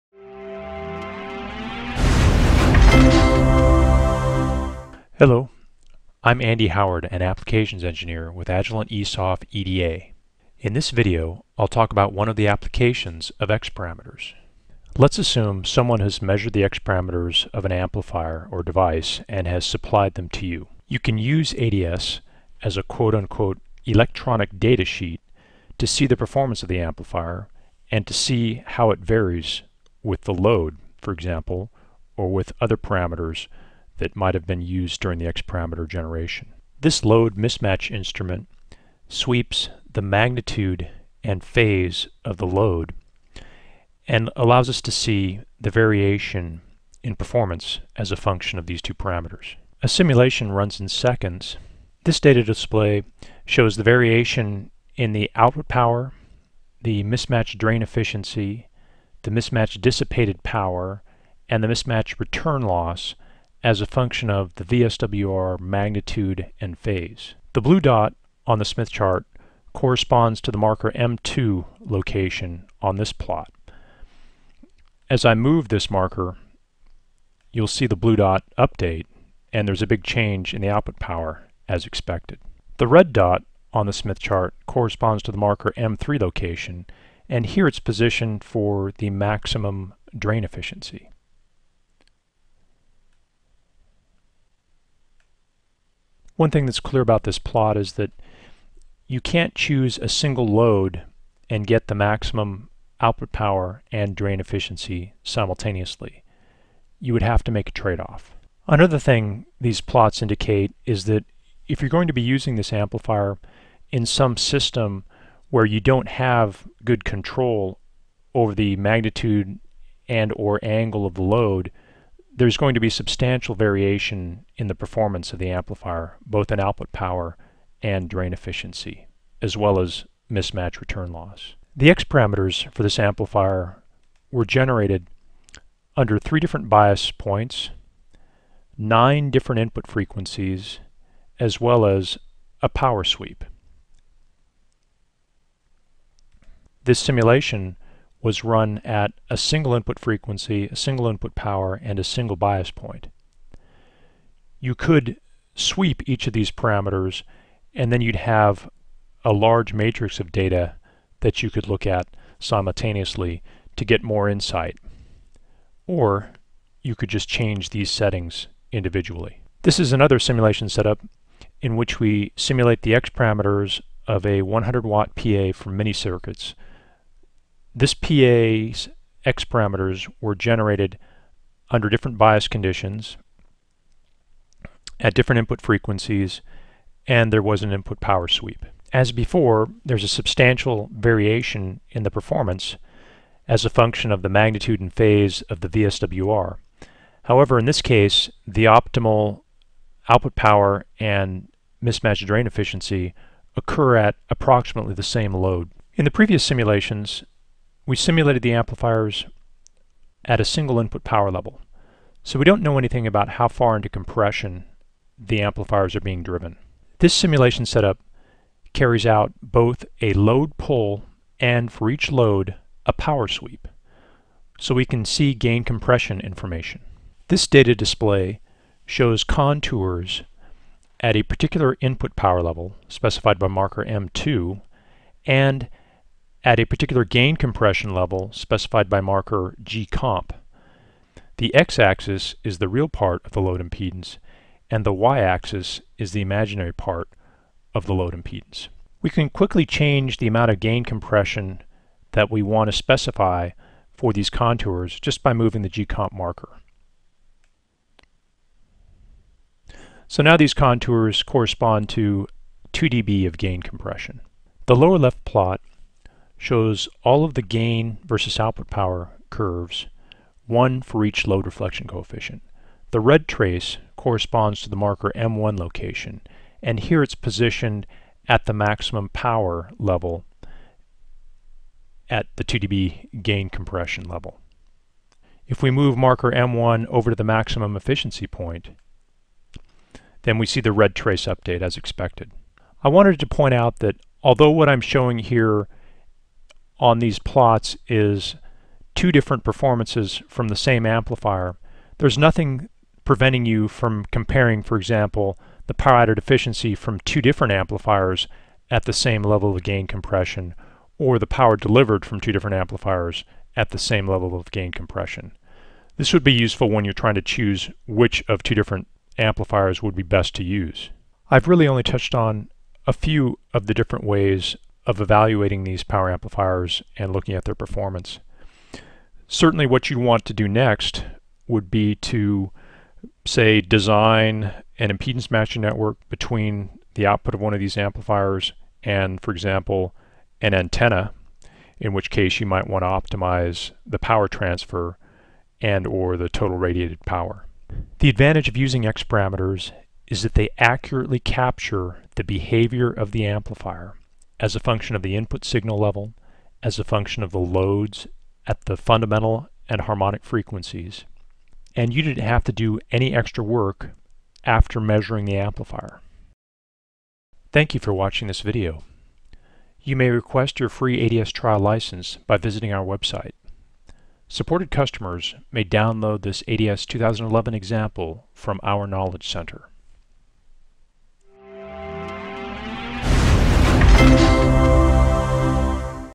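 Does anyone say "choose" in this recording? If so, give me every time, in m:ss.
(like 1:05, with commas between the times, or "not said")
1:39, 5:17.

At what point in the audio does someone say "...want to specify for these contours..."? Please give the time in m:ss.
4:12.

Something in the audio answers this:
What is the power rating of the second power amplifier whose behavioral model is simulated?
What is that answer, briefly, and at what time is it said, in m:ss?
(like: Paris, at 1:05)
100 watt, at 2:54.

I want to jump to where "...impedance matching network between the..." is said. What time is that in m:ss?
5:34.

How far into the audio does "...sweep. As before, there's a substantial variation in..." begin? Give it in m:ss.
3:08.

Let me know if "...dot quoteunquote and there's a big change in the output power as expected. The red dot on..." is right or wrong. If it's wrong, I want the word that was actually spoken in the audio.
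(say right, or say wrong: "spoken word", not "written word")
wrong: "update", not "quoteunquote".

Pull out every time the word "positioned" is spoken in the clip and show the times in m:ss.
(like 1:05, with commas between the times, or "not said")
1:27, 4:37.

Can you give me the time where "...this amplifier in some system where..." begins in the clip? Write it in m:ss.
1:52.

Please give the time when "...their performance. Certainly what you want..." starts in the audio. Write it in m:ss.
5:27.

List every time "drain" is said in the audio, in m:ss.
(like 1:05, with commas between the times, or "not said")
0:57, 1:30, 1:44, 2:08, 3:22.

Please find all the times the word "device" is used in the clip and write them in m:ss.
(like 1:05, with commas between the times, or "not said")
0:18.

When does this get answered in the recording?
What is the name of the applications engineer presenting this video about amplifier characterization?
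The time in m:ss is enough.
0:06.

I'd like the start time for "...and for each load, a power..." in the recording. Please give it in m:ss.
3:41.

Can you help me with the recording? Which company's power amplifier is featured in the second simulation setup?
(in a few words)
Mini-Circuits.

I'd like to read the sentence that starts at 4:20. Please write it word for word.
So now these contours correspond to 2 dB of gain compression.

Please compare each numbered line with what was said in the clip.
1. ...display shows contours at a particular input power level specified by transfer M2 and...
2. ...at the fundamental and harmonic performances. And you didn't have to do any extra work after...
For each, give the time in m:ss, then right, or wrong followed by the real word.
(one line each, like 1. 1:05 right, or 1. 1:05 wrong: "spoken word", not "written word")
1. 3:47 wrong: "marker", not "transfer"
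2. 5:58 wrong: "frequencies", not "performances".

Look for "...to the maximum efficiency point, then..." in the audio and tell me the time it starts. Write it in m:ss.
4:47.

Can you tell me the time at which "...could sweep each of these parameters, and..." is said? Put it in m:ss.
2:34.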